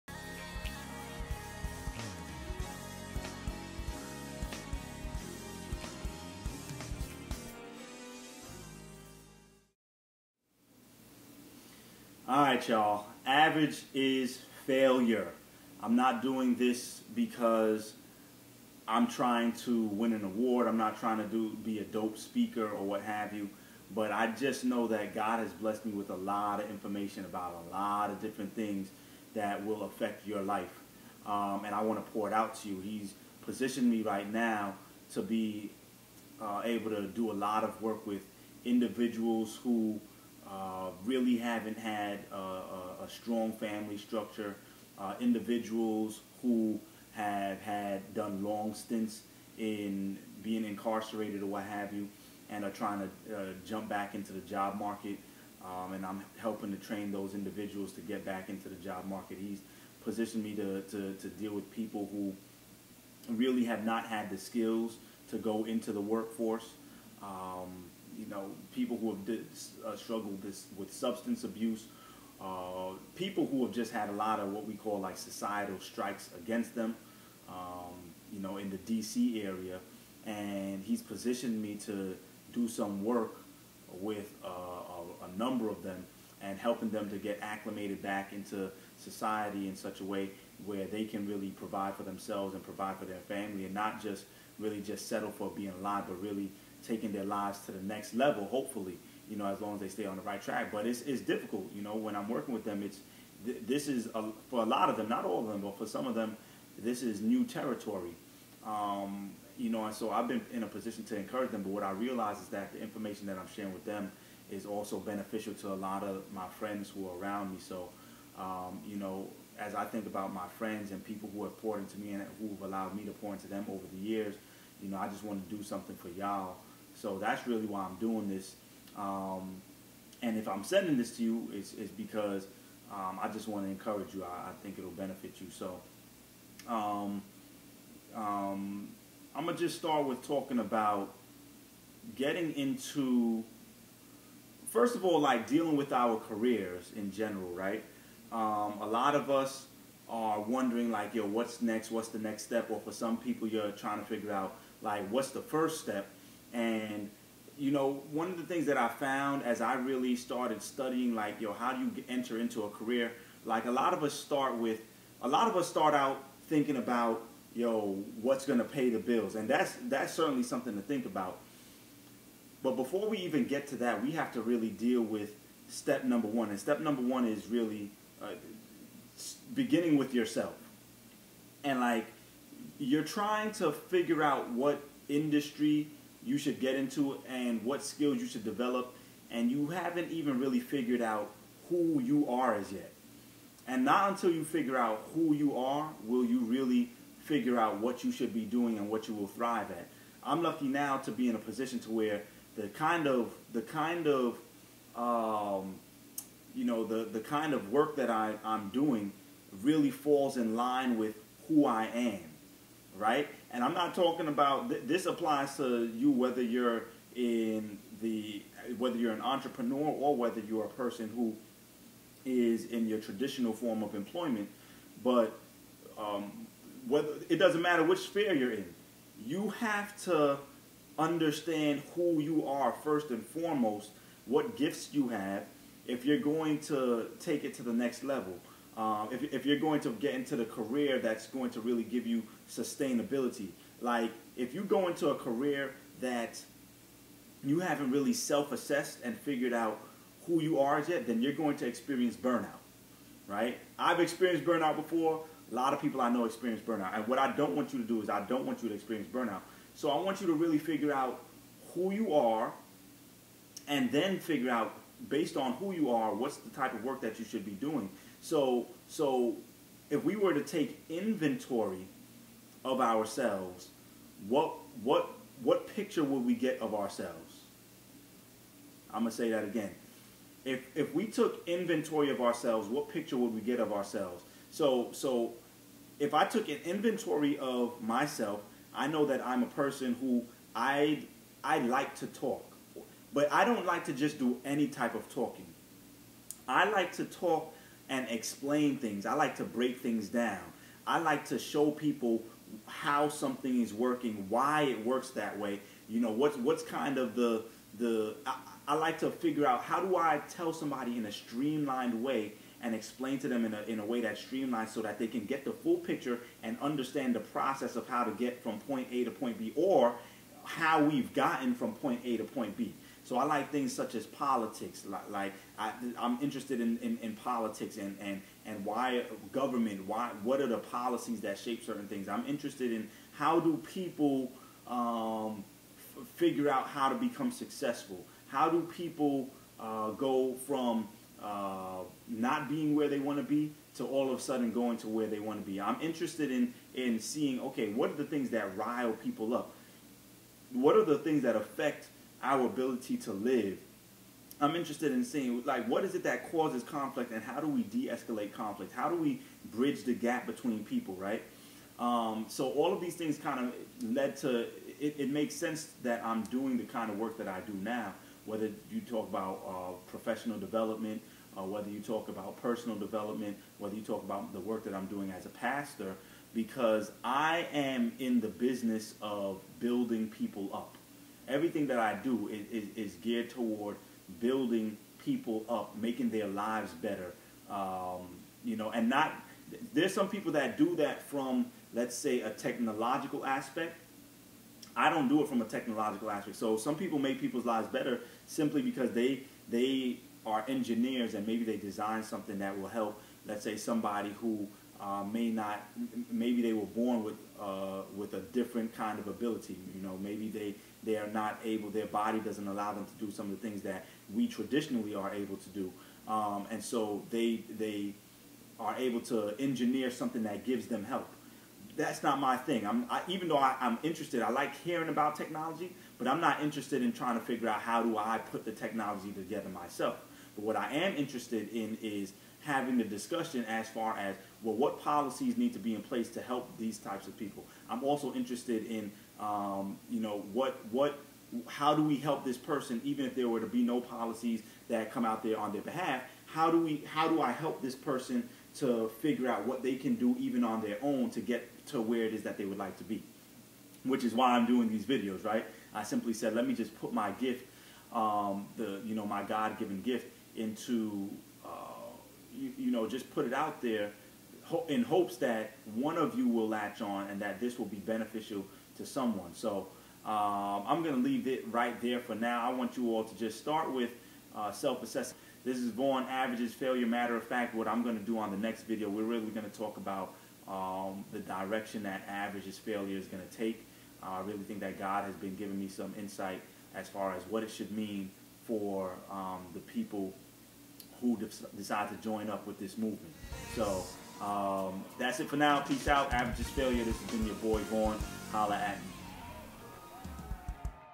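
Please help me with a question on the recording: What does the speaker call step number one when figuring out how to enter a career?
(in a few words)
Beginning with yourself.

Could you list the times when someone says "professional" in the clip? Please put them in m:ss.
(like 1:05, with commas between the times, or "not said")
6:09.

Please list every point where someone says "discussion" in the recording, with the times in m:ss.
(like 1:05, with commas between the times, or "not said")
7:12.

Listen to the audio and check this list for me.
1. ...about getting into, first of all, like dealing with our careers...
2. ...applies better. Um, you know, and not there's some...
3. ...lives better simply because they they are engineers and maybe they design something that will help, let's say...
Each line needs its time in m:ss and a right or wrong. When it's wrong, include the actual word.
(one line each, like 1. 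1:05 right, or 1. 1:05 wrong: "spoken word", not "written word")
1. 2:20 right
2. 6:26 wrong: "lives", not "applies"
3. 6:37 right.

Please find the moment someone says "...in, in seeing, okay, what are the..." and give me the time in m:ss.
5:46.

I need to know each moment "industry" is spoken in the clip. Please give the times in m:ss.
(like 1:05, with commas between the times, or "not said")
3:05.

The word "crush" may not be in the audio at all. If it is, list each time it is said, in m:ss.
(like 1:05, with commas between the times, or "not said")
not said.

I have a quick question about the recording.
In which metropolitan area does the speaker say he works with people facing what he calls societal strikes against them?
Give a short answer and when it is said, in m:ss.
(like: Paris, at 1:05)
D.C., at 1:18.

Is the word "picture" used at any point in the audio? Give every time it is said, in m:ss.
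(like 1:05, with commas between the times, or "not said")
4:35, 4:42, 5:15.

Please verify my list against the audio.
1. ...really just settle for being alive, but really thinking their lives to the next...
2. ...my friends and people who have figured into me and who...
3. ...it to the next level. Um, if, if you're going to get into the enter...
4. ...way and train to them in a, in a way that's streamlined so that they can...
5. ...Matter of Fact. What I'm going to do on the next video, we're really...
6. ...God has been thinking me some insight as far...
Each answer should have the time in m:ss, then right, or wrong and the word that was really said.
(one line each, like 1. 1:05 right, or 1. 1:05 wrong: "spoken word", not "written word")
1. 1:34 wrong: "taking", not "thinking"
2. 2:00 wrong: "poured", not "figured"
3. 3:57 wrong: "career", not "enter"
4. 5:12 wrong: "explain", not "train"
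5. 7:56 right
6. 8:04 wrong: "giving", not "thinking".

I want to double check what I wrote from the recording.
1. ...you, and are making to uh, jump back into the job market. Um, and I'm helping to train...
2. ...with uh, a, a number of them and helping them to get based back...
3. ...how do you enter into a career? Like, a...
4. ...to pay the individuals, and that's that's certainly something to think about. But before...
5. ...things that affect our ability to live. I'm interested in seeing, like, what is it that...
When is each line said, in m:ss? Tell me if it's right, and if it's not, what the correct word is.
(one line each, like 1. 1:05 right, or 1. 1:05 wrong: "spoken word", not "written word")
1. 0:51 wrong: "trying", not "making"
2. 1:23 wrong: "acclimated", not "based"
3. 2:41 right
4. 2:48 wrong: "bills", not "individuals"
5. 5:50 right.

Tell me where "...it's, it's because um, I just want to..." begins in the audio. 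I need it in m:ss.
2:11.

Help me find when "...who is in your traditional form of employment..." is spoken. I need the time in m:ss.
3:41.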